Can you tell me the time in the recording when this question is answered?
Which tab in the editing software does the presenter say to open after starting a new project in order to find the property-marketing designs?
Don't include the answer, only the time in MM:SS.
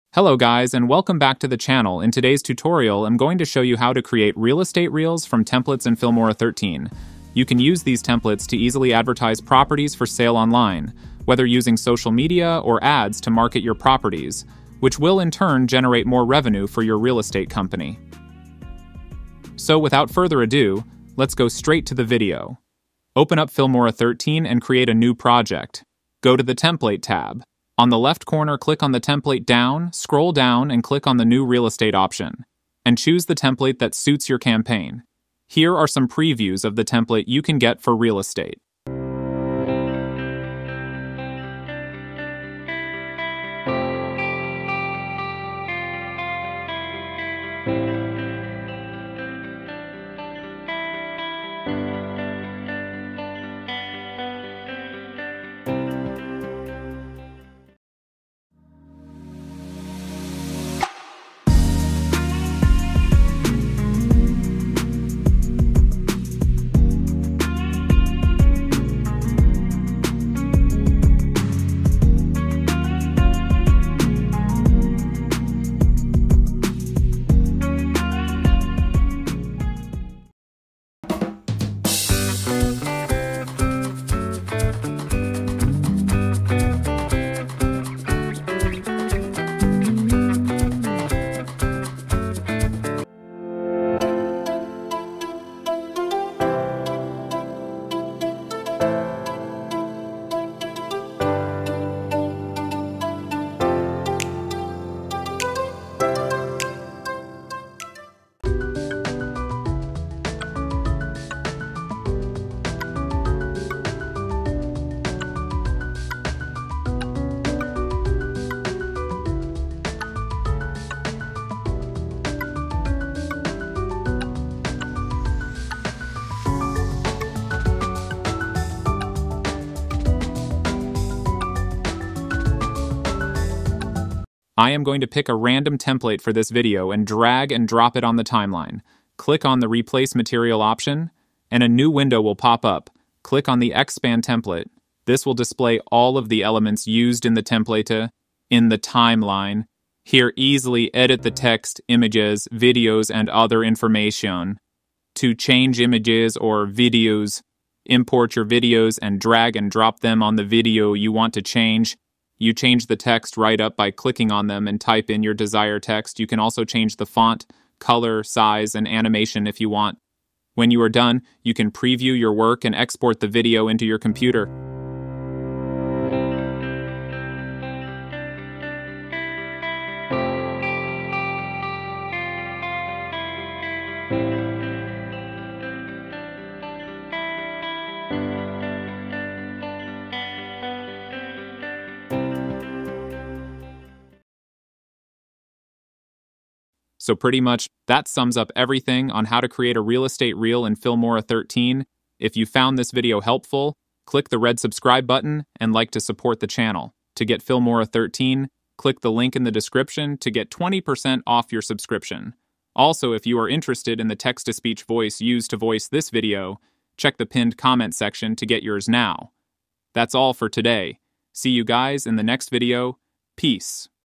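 00:26.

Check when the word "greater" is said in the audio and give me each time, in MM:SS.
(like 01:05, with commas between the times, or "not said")
not said.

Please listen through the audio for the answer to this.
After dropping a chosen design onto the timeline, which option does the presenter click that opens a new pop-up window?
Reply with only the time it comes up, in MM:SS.
02:19.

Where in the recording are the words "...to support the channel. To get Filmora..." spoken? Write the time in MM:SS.
03:25.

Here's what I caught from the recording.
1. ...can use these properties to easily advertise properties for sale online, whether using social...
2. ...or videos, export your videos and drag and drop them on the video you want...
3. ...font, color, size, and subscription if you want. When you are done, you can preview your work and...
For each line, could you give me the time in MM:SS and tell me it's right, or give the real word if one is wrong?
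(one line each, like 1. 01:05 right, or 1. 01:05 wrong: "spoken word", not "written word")
1. 00:07 wrong: "templates", not "properties"
2. 02:36 wrong: "import", not "export"
3. 02:47 wrong: "animation", not "subscription".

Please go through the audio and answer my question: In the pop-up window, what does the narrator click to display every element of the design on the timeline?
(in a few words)
Expand Template.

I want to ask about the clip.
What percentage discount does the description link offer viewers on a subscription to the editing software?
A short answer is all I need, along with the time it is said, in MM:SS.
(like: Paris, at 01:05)
20%, at 03:30.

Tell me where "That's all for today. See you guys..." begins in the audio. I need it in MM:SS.
03:39.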